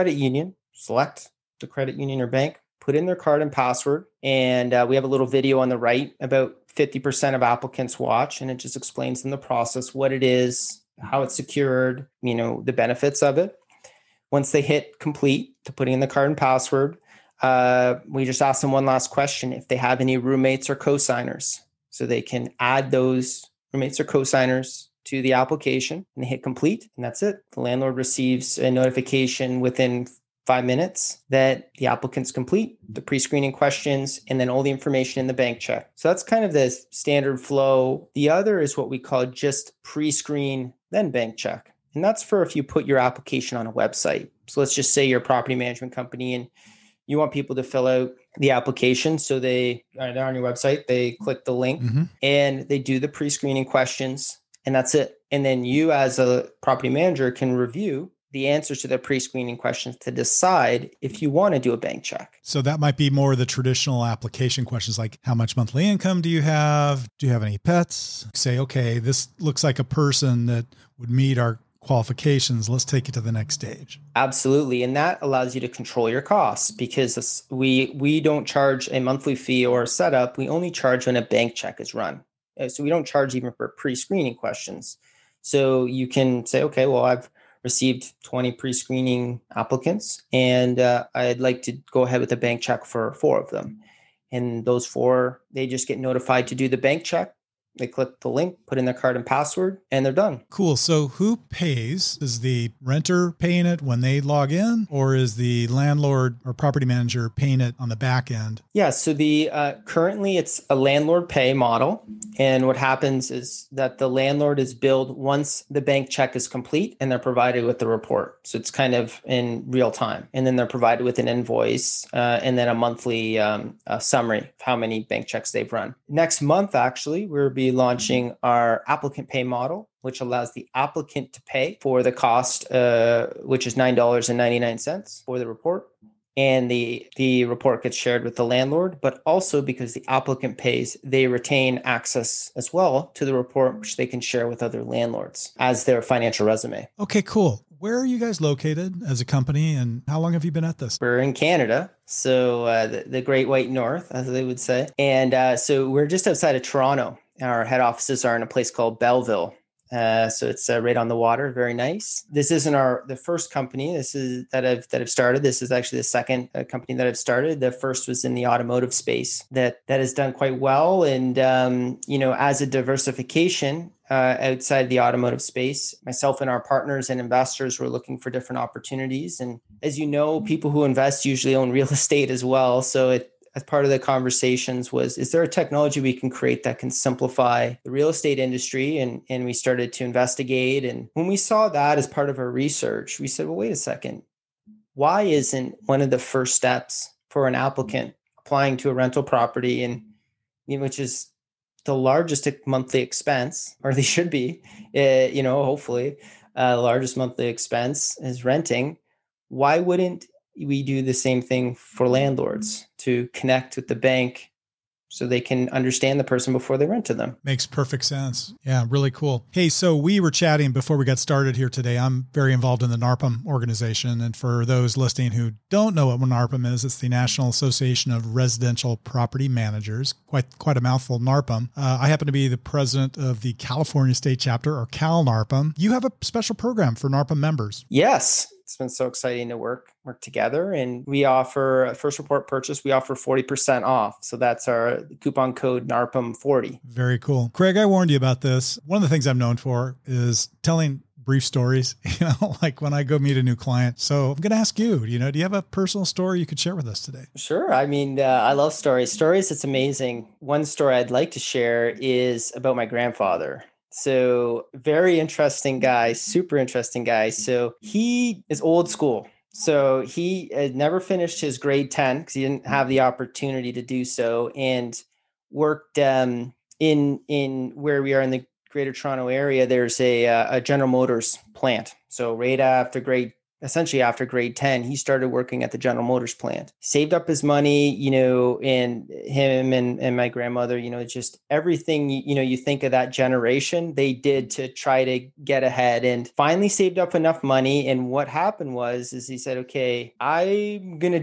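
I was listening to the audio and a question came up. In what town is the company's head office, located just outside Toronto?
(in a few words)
Belleville.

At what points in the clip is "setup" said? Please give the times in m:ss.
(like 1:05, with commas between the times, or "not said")
1:19.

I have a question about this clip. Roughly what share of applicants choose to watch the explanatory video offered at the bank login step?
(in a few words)
50%.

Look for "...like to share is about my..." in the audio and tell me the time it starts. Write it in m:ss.
4:21.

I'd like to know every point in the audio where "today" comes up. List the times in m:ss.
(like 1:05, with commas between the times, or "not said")
3:41, 4:17.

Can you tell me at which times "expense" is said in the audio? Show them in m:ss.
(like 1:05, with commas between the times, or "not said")
3:23, 3:27.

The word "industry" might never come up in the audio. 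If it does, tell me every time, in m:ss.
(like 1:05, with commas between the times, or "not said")
3:08.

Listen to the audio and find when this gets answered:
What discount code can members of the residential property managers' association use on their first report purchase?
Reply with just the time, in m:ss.
4:05.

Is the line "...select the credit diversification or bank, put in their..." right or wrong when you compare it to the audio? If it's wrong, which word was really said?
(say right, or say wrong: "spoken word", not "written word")
wrong: "union", not "diversification".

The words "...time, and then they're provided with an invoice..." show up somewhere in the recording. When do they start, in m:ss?
1:59.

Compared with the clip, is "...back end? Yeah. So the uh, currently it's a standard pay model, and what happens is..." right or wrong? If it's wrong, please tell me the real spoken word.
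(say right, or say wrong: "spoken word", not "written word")
wrong: "landlord", not "standard".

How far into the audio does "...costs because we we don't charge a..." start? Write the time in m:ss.
1:16.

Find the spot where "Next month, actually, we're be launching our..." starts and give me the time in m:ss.
2:06.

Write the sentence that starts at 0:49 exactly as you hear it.
So they are uh, on your website, they click the link mm-hmm.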